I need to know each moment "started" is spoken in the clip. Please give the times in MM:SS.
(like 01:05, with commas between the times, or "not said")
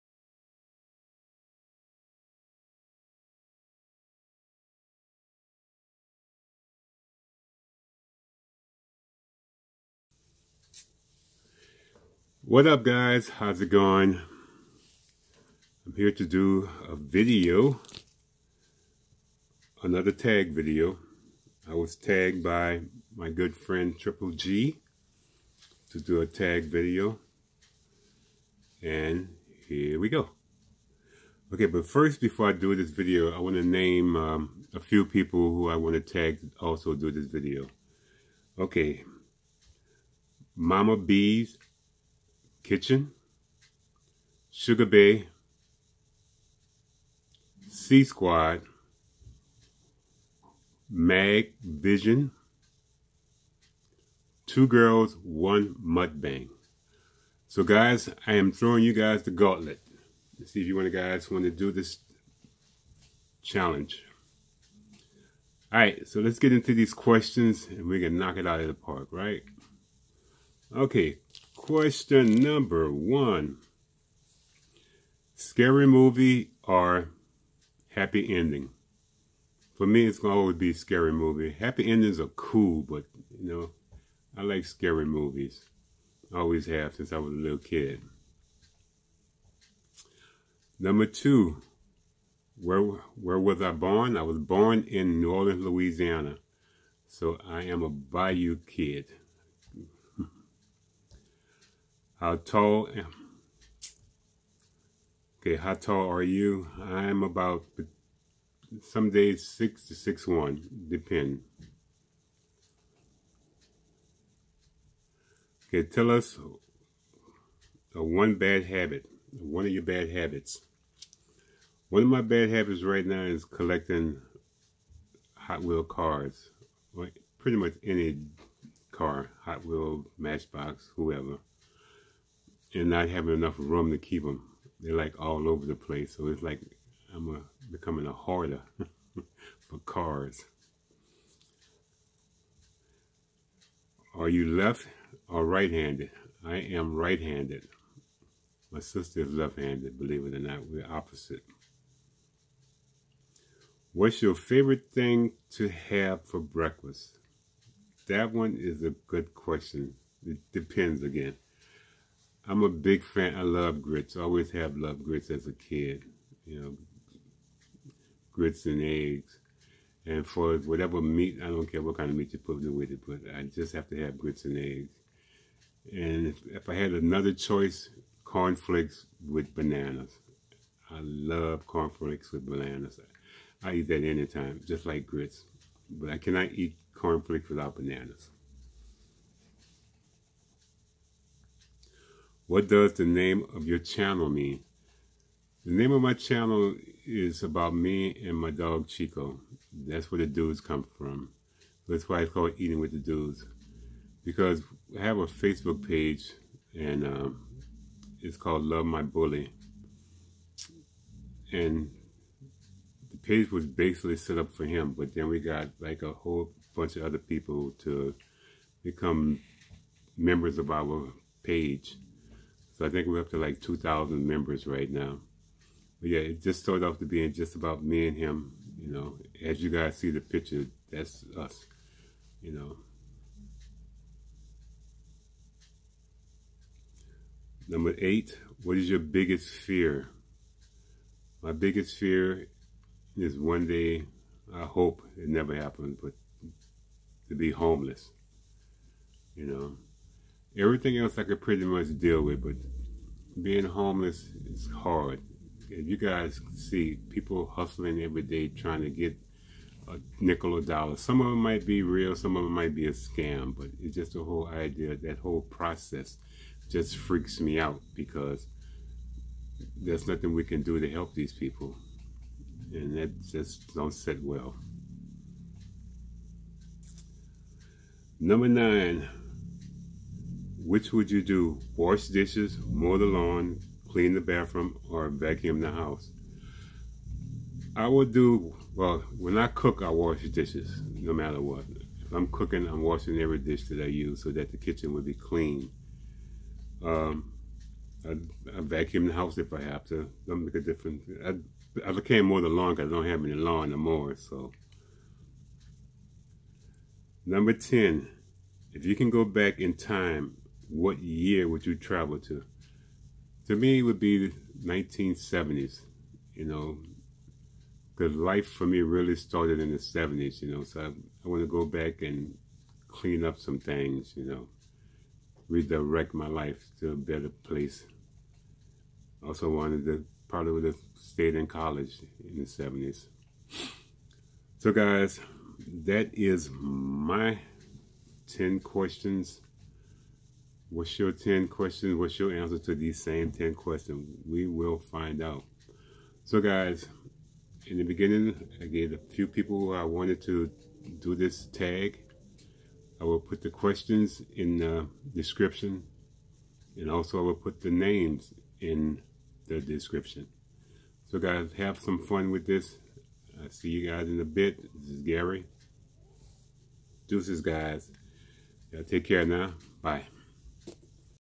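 03:46, 05:19.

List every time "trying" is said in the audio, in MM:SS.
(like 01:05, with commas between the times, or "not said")
04:18.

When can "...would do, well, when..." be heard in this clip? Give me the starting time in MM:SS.
04:47.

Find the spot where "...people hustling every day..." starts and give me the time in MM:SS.
04:17.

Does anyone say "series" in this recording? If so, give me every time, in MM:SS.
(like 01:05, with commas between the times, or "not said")
not said.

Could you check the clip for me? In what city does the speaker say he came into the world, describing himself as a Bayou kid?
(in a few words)
New Orleans.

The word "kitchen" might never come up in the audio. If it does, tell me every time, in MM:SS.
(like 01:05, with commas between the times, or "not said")
00:42, 04:54.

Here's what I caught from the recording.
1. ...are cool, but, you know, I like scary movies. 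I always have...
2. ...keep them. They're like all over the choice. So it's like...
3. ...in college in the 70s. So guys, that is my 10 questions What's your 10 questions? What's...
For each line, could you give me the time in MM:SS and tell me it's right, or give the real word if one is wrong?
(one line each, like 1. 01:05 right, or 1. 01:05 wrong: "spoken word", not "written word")
1. 01:22 right
2. 02:13 wrong: "place", not "choice"
3. 05:31 right.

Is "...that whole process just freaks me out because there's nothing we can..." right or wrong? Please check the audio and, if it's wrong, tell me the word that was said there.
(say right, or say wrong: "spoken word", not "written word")
right.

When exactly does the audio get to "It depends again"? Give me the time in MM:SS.
02:40.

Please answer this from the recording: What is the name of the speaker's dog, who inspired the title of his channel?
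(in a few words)
Chico.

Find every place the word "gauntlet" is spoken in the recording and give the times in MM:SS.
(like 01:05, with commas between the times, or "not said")
00:59.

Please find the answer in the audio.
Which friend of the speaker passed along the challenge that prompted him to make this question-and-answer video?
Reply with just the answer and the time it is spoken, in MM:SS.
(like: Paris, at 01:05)
Triple G, at 00:23.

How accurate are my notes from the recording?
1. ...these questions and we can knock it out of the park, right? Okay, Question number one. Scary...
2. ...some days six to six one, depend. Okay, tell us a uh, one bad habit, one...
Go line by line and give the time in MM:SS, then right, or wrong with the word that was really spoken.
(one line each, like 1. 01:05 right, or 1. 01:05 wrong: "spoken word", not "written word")
1. 01:06 right
2. 01:48 right.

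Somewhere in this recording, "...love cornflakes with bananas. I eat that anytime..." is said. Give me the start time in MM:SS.
03:01.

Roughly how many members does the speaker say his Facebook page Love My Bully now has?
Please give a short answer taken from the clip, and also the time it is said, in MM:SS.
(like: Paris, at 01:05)
2,000, at 03:43.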